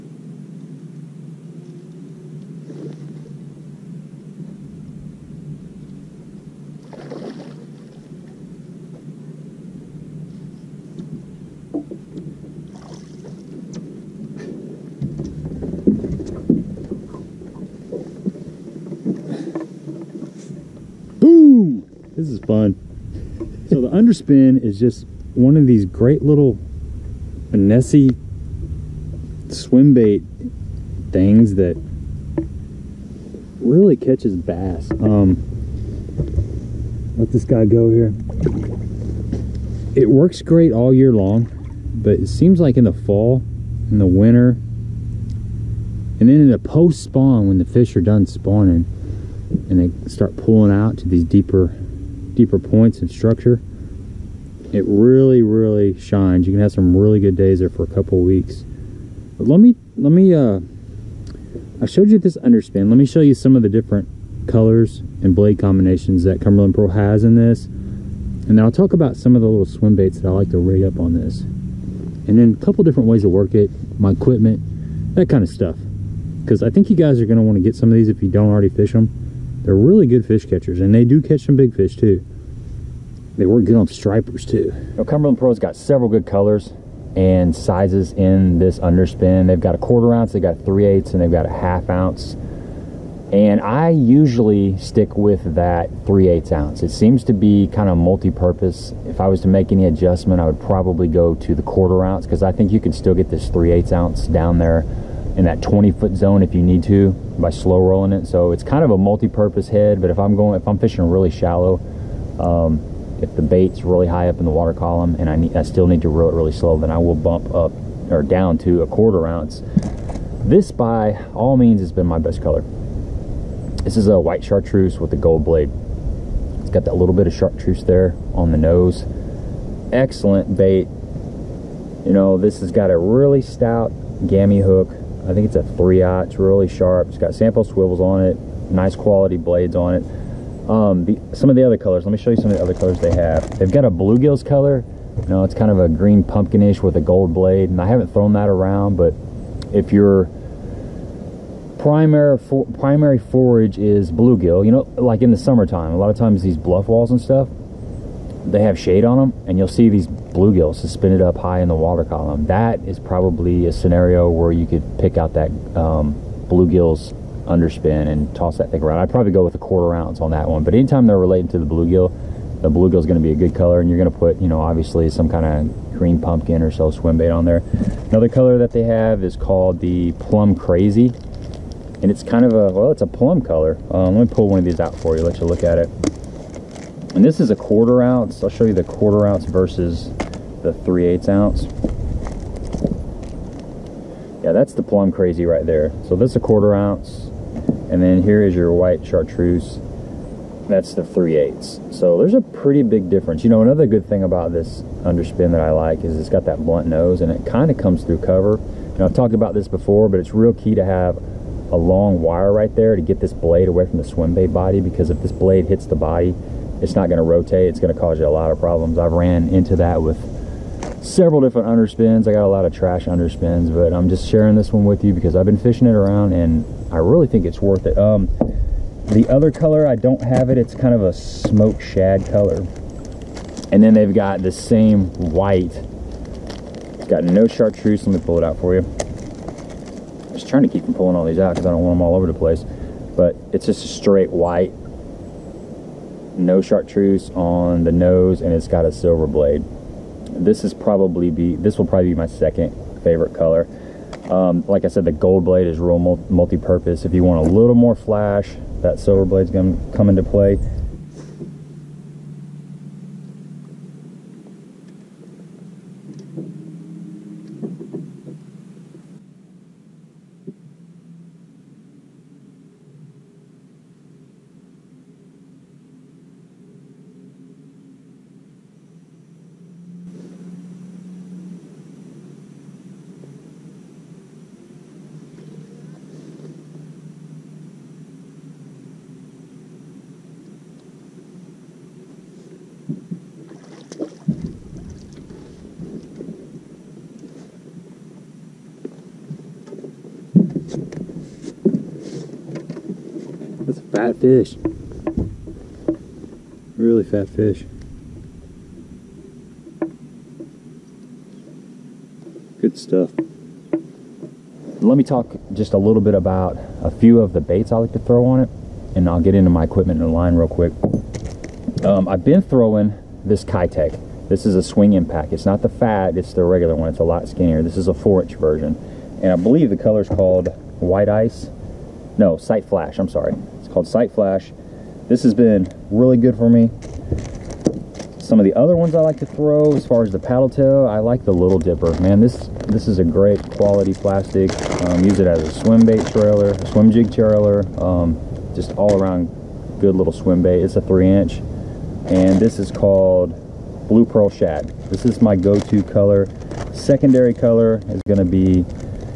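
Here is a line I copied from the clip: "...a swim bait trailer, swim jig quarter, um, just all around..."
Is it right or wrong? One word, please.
wrong.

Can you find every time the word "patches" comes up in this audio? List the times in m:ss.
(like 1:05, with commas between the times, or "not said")
not said.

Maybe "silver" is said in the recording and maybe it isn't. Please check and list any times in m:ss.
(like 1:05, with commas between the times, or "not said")
4:08, 4:18.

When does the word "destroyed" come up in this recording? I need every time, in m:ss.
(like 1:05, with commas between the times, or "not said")
not said.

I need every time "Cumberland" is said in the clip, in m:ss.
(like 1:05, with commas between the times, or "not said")
1:06, 1:25.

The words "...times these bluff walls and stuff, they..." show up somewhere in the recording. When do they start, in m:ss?
2:36.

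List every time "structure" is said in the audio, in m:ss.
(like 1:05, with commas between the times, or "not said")
0:53.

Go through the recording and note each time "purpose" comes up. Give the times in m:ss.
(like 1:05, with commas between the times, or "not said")
1:38, 1:48, 4:16.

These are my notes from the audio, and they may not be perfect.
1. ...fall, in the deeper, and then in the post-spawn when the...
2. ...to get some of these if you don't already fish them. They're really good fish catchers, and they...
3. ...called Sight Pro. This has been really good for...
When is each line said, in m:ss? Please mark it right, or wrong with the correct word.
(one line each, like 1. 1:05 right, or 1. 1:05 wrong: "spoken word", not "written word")
1. 0:42 wrong: "winter", not "deeper"
2. 1:17 right
3. 5:33 wrong: "Flash", not "Pro".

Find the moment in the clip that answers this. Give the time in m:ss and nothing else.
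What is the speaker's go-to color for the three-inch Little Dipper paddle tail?
5:53.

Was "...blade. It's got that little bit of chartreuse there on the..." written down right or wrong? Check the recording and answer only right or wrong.
right.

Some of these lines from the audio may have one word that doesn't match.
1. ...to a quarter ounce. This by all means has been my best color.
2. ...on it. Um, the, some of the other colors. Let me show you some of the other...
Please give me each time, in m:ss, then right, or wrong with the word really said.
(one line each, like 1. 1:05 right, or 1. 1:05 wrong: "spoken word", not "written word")
1. 1:58 right
2. 2:19 right.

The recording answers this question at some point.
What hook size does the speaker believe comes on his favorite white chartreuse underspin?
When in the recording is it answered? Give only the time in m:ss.
2:15.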